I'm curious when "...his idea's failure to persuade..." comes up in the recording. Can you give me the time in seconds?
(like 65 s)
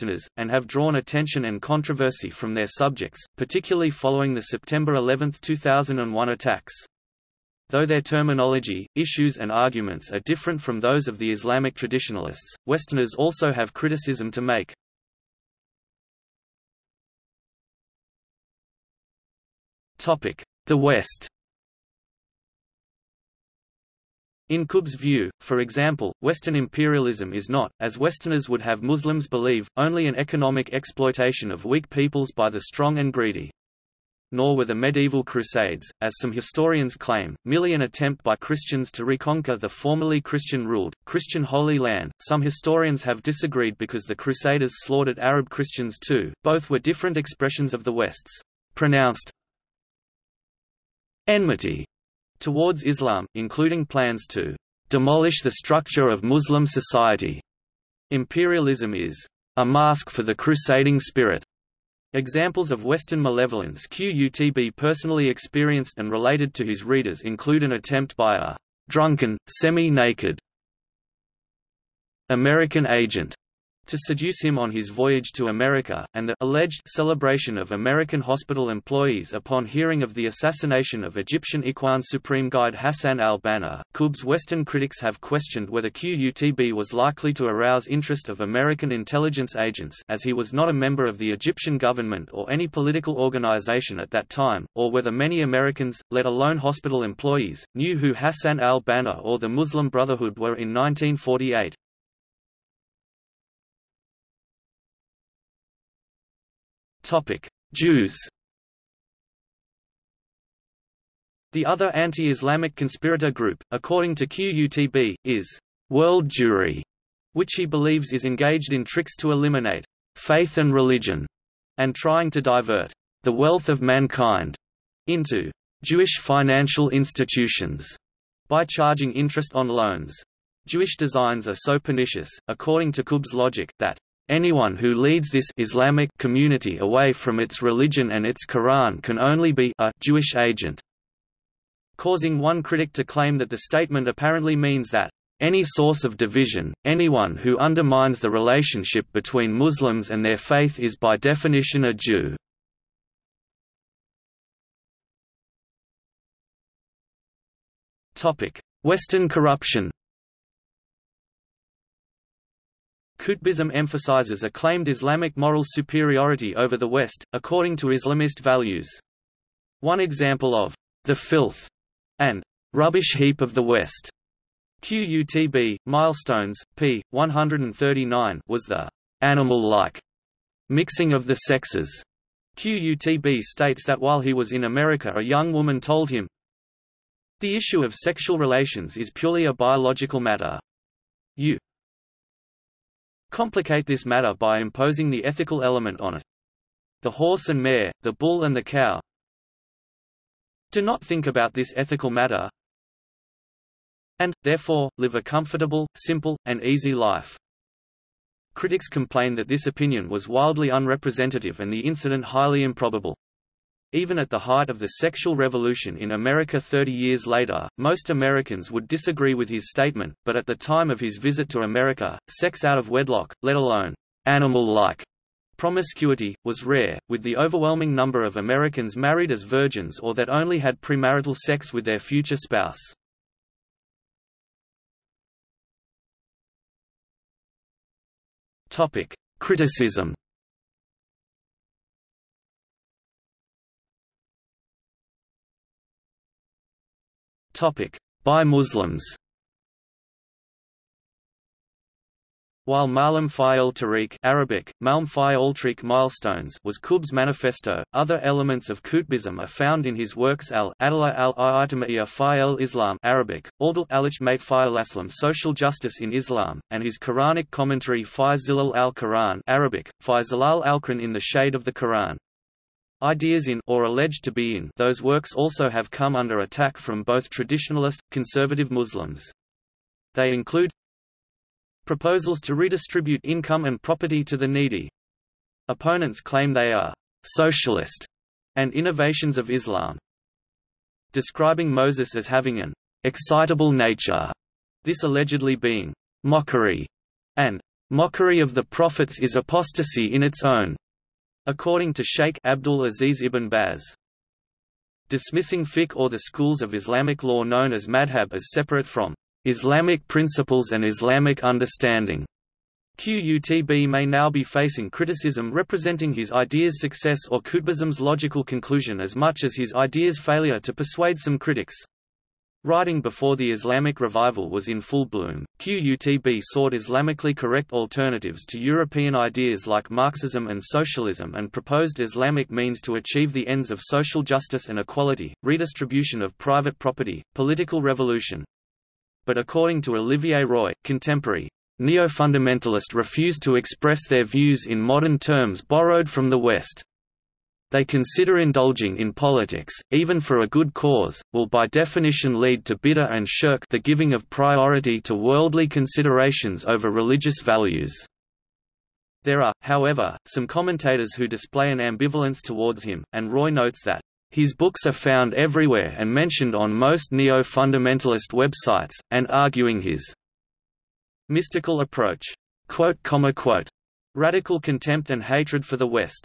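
319 s.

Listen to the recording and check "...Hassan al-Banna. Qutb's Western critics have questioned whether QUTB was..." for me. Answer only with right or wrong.
right.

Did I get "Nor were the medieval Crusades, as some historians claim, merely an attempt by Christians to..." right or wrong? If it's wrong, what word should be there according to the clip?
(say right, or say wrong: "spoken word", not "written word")
right.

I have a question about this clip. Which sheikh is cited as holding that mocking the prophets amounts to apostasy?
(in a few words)
Abdul Aziz ibn Baz.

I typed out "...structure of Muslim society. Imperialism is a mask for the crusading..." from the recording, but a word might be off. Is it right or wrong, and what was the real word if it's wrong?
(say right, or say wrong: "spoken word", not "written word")
right.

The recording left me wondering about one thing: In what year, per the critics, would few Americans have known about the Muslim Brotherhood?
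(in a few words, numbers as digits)
1948.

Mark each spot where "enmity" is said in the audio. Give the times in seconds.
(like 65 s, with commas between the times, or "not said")
51 s.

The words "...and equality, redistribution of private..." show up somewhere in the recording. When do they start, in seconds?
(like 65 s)
334 s.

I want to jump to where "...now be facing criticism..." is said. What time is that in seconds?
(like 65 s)
314 s.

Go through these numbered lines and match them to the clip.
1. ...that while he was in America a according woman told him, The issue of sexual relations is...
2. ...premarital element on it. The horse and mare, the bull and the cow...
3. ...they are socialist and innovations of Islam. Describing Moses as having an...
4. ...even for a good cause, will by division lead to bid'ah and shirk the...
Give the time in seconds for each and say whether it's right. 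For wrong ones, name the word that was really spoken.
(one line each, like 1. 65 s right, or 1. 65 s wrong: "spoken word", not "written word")
1. 183 s wrong: "young", not "according"
2. 195 s wrong: "ethical", not "premarital"
3. 286 s right
4. 349 s wrong: "definition", not "division".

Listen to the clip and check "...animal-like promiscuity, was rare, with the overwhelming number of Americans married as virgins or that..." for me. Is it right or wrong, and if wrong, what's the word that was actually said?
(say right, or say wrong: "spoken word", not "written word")
right.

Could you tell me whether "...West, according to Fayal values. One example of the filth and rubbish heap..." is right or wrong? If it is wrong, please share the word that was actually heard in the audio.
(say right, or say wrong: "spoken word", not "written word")
wrong: "Islamist", not "Fayal".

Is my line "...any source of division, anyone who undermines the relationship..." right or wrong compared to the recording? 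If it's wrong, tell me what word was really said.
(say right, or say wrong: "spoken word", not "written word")
right.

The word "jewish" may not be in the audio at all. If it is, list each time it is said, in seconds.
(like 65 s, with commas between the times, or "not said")
125 s, 130 s, 140 s.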